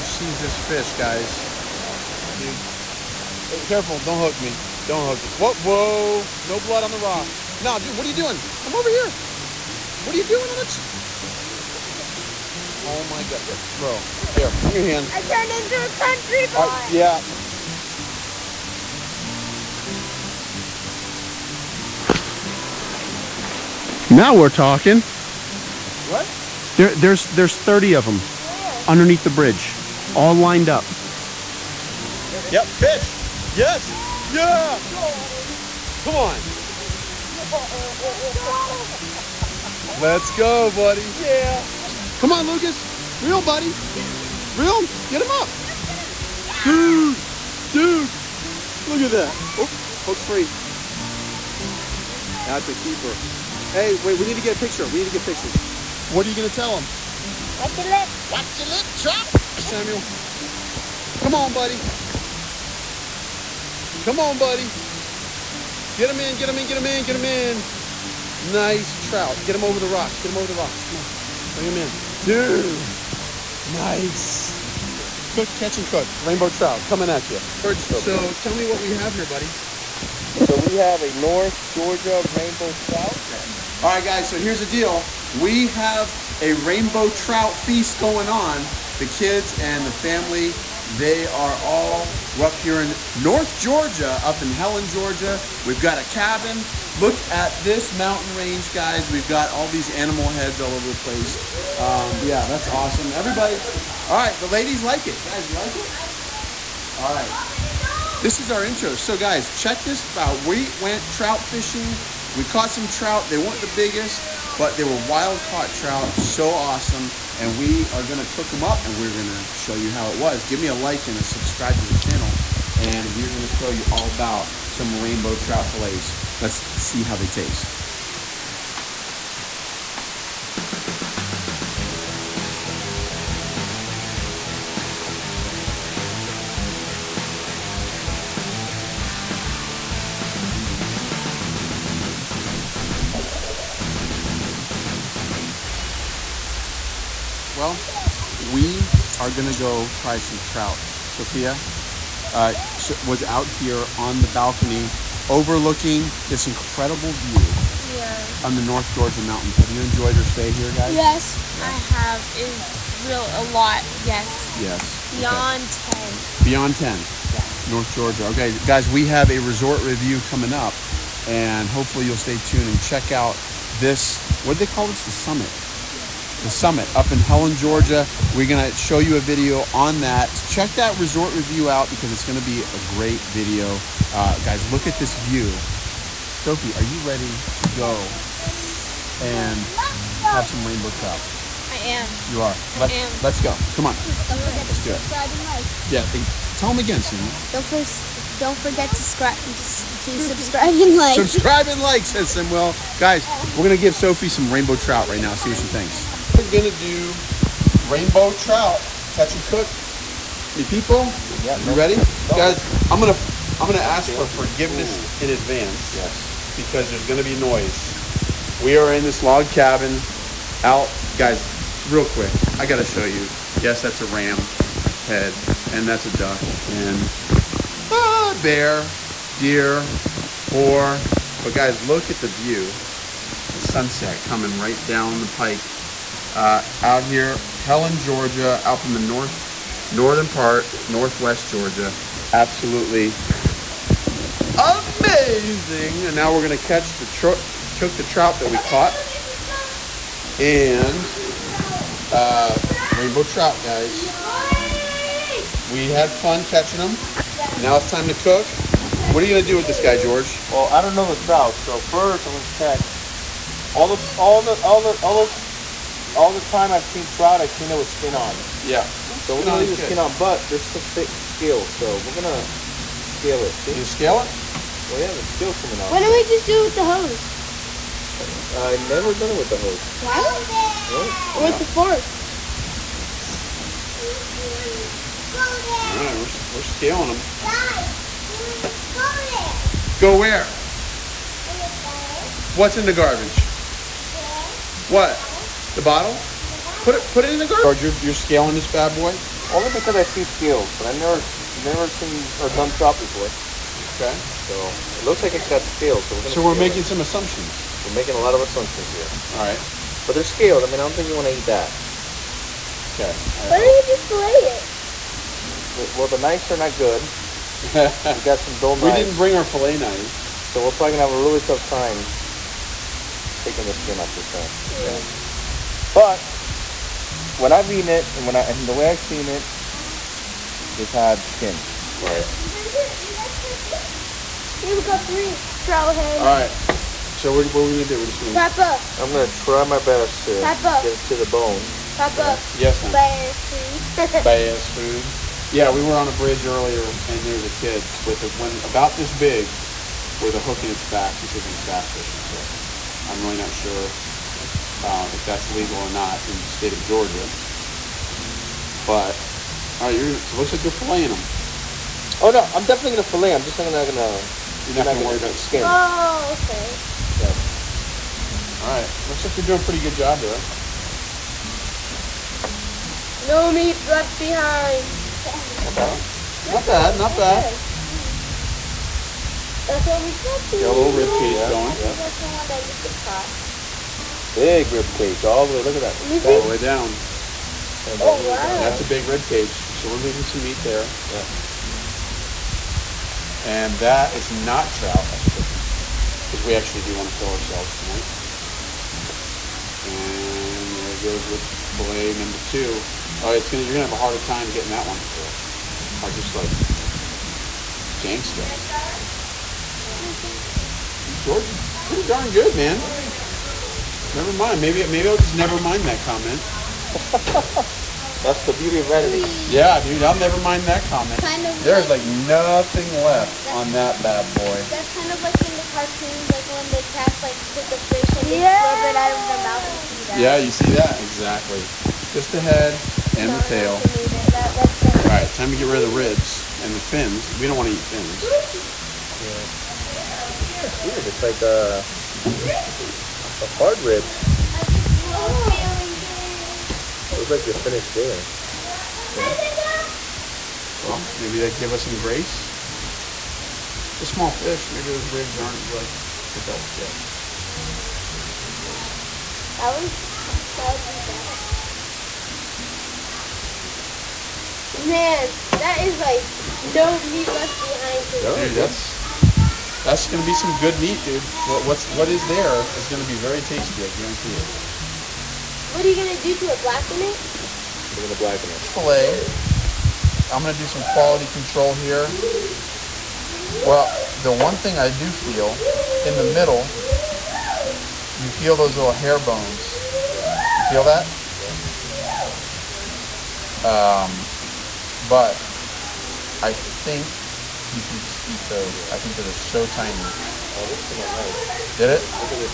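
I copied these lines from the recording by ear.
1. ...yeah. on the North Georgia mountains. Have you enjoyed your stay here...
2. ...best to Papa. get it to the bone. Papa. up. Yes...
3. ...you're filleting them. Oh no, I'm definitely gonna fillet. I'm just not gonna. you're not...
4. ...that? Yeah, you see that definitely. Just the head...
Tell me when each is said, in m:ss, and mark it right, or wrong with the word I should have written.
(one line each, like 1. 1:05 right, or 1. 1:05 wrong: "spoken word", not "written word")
1. 2:37 right
2. 5:39 right
3. 6:00 right
4. 7:10 wrong: "exactly", not "definitely".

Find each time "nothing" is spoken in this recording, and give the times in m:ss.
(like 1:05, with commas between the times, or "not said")
7:02.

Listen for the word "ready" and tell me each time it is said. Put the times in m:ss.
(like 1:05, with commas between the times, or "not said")
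3:06, 3:31.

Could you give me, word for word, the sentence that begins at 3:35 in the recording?
Yes, because there's gonna be noise.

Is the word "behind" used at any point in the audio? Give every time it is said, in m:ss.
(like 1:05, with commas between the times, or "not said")
6:14, 7:47.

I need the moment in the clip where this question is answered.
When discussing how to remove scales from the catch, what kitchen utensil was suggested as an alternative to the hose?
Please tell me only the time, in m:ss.
4:41.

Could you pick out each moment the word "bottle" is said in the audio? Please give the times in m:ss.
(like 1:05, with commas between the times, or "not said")
4:55.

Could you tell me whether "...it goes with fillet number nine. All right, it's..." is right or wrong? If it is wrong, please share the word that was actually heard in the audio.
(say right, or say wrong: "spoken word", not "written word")
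wrong: "two", not "nine".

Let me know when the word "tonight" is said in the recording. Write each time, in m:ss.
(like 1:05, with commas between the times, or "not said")
6:37.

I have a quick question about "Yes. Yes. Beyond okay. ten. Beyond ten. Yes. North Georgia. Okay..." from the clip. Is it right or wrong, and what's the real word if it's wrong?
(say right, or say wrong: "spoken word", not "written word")
right.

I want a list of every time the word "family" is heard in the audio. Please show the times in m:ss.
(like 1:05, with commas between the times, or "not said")
1:29.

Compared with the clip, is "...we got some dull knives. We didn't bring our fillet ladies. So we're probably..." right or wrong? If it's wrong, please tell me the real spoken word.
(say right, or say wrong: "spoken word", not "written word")
wrong: "knives", not "ladies".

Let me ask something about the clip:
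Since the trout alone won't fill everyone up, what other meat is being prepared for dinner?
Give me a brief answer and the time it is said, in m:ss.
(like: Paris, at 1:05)
Chicken, at 6:35.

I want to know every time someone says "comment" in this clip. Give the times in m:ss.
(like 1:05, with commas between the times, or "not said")
6:56, 7:00.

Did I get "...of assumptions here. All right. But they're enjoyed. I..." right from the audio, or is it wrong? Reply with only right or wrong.
wrong.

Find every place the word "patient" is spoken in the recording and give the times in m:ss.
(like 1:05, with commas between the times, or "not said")
not said.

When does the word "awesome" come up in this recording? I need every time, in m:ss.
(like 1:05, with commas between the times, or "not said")
1:42, 1:56.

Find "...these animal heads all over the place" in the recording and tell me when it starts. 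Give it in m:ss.
1:39.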